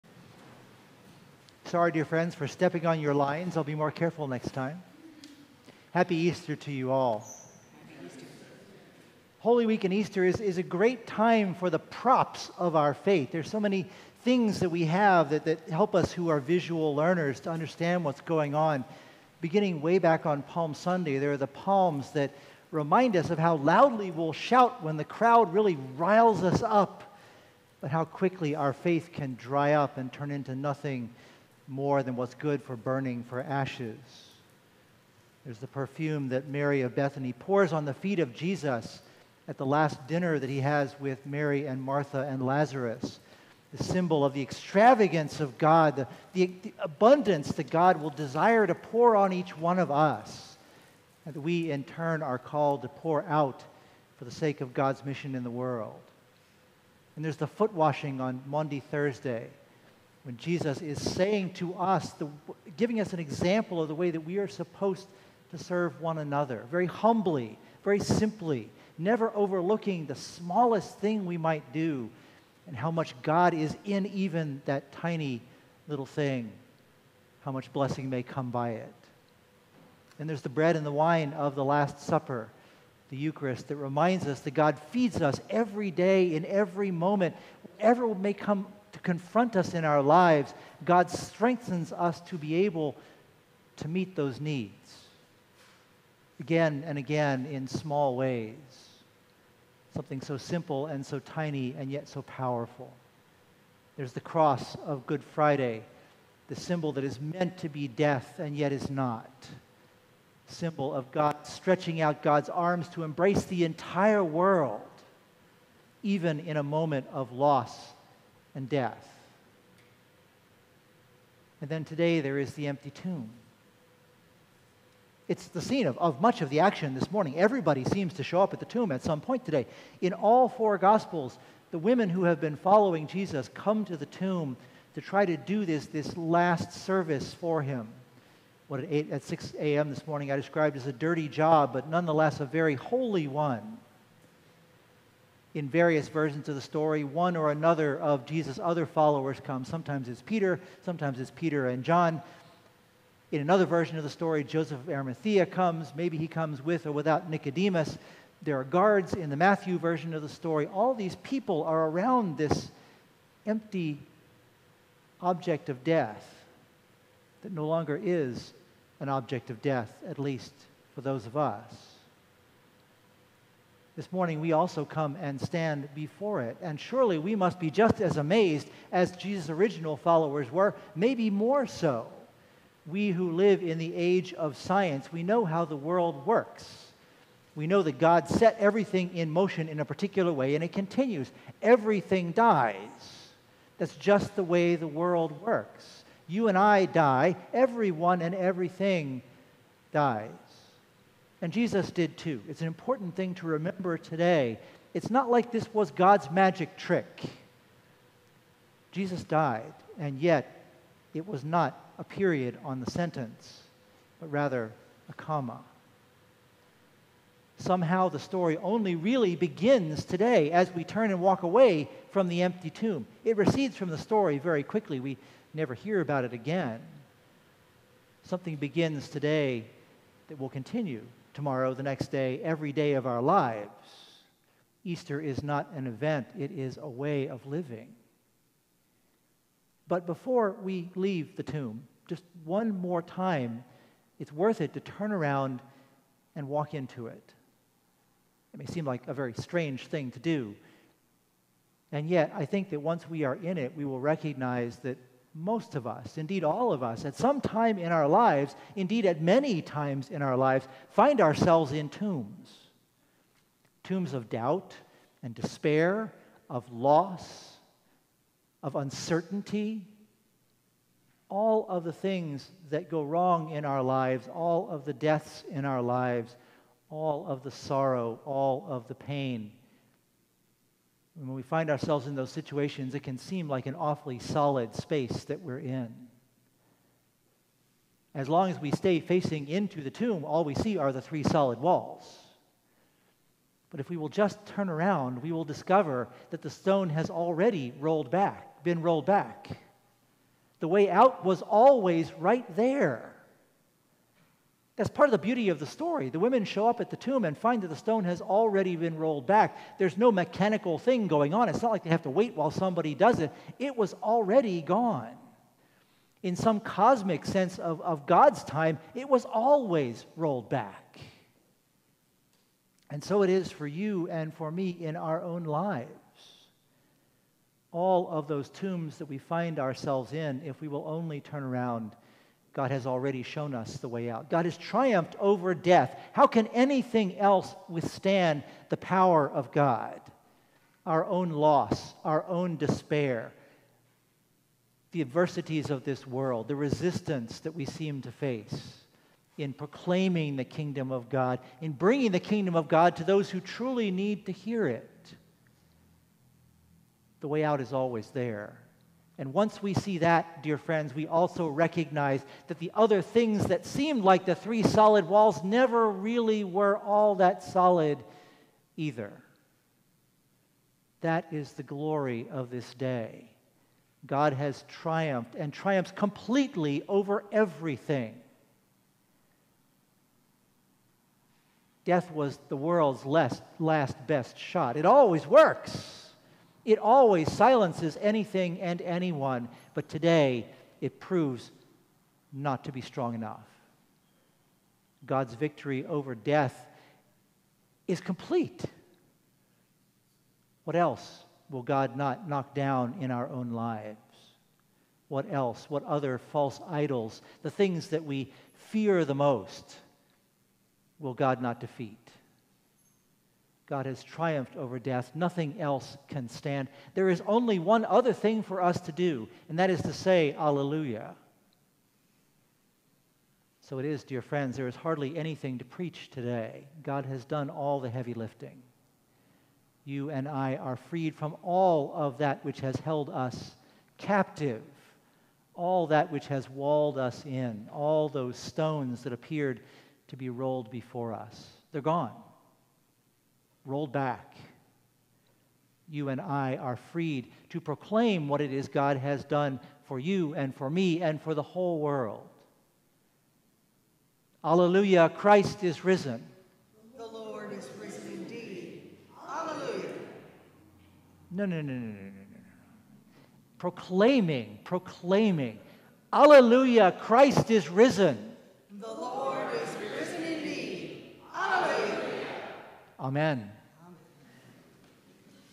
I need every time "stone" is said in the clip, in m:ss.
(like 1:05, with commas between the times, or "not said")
4:56, 5:07, 7:18.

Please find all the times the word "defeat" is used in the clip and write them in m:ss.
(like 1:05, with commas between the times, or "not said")
6:51.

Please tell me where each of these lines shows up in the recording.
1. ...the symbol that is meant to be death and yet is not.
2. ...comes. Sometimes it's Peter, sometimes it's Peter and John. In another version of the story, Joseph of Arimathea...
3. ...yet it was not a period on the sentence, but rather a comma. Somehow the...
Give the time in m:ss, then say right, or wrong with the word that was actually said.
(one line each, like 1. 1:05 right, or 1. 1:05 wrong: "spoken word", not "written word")
1. 1:46 right
2. 2:29 right
3. 3:30 right.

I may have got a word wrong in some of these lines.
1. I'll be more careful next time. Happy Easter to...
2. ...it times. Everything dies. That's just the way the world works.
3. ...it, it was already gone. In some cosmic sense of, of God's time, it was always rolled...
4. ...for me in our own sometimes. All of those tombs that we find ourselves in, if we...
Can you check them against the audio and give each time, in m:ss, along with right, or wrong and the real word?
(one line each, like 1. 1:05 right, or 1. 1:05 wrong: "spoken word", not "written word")
1. 0:03 right
2. 3:10 wrong: "continues", not "times"
3. 5:13 right
4. 5:24 wrong: "lives", not "sometimes".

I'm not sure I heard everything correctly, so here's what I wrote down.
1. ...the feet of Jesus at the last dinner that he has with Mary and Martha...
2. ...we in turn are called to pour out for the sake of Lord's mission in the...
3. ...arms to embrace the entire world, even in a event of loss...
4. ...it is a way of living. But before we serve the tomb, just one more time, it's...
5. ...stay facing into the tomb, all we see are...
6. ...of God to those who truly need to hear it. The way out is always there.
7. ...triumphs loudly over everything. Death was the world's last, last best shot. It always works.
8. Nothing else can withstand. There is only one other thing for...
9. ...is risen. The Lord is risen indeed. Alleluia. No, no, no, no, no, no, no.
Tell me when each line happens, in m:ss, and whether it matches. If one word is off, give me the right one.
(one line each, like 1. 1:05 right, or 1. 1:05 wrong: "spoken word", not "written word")
1. 0:37 right
2. 0:51 wrong: "God", not "Lord"
3. 1:52 wrong: "moment", not "event"
4. 3:56 wrong: "leave", not "serve"
5. 4:48 right
6. 5:52 right
7. 6:15 wrong: "completely", not "loudly"
8. 6:55 wrong: "stand", not "withstand"
9. 7:35 right.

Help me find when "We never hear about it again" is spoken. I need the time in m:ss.
3:44.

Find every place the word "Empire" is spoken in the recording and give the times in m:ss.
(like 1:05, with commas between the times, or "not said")
not said.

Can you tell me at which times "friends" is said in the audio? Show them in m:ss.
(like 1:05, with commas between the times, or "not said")
0:02, 6:00, 7:04.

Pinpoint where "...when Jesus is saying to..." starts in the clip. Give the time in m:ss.
1:00.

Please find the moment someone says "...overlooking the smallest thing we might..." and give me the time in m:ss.
1:09.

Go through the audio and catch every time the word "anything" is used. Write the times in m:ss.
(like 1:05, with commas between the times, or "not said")
5:36, 6:28, 7:05.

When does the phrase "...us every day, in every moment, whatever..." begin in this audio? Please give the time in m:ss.
1:25.